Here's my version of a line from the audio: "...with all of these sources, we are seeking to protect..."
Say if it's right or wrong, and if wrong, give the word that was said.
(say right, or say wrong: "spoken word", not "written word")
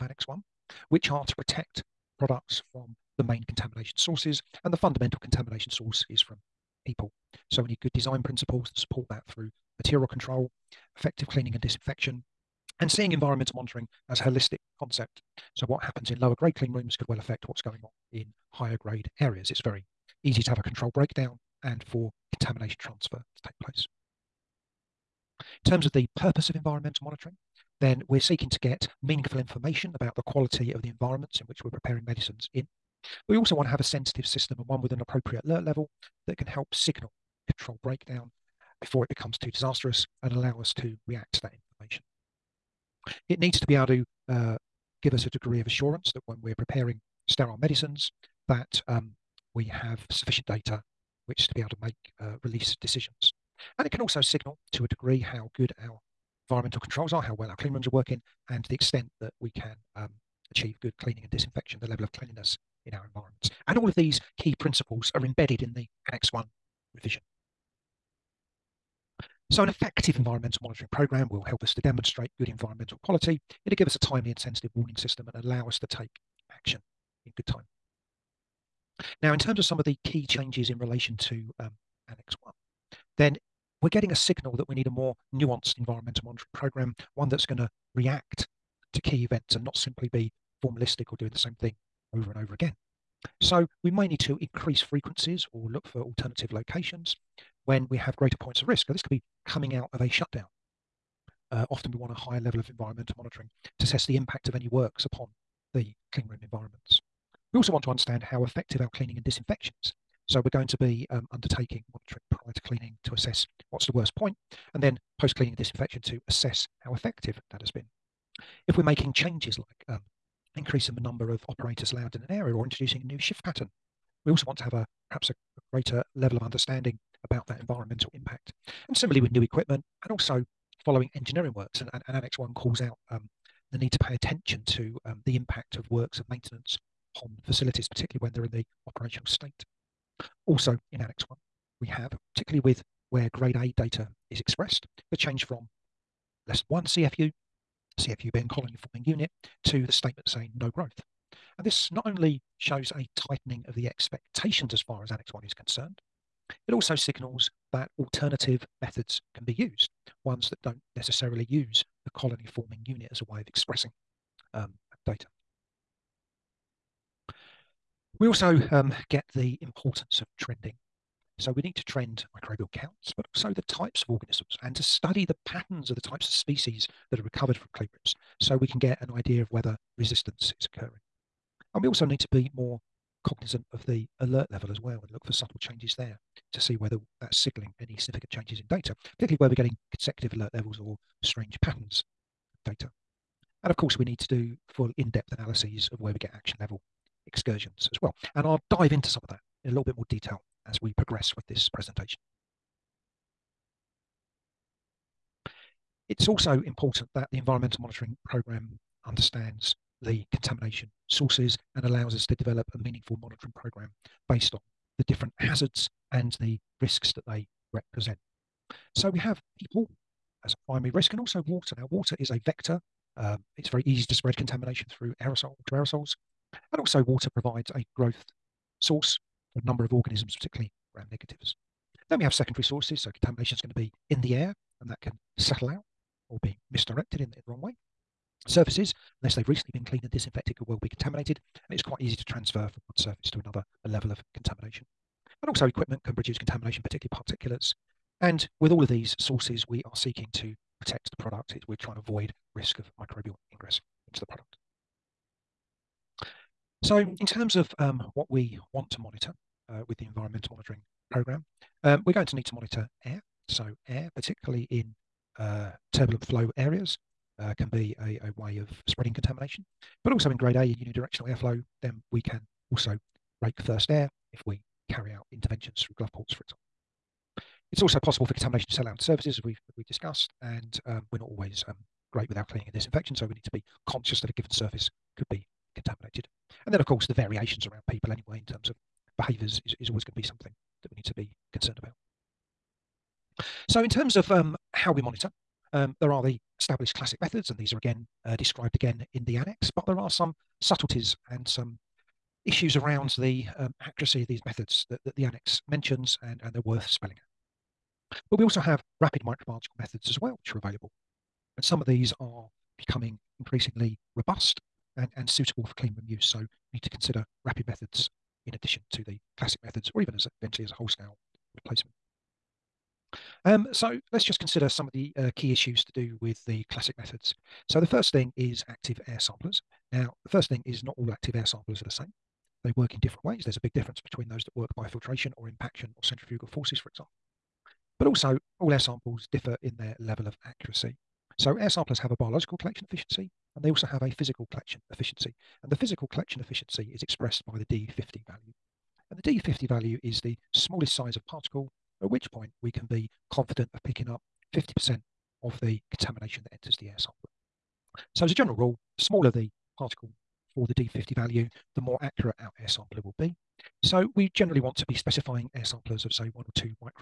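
right.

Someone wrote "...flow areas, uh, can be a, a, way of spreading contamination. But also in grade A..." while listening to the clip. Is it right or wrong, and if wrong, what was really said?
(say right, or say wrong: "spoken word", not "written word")
right.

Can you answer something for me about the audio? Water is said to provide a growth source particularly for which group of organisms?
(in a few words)
Gram negatives.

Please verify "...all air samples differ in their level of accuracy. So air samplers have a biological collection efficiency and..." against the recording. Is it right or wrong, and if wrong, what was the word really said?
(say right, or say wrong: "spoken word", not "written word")
right.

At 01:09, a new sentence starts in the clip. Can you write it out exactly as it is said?
So, an effective environmental monitoring program will help us to demonstrate good environmental quality.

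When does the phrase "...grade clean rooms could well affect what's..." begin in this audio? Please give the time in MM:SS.
00:16.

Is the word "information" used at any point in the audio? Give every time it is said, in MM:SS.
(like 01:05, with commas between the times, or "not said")
00:29, 00:41.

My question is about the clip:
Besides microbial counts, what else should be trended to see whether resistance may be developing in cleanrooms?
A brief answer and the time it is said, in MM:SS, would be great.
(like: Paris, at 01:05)
Types of organisms, at 02:53.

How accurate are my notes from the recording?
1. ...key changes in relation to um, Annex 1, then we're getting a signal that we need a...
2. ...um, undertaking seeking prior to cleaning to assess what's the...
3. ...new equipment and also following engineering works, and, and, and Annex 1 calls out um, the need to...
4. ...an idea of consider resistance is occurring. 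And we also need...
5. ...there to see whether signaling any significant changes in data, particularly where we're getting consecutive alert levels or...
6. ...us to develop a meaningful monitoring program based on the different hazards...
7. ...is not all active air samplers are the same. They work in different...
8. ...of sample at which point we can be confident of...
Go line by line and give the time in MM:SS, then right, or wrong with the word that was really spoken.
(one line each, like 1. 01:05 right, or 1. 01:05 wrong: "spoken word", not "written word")
1. 01:20 right
2. 01:51 wrong: "monitoring", not "seeking"
3. 02:09 right
4. 02:59 wrong: "whether", not "consider"
5. 03:05 right
6. 03:32 right
7. 05:30 right
8. 05:51 wrong: "particle", not "sample".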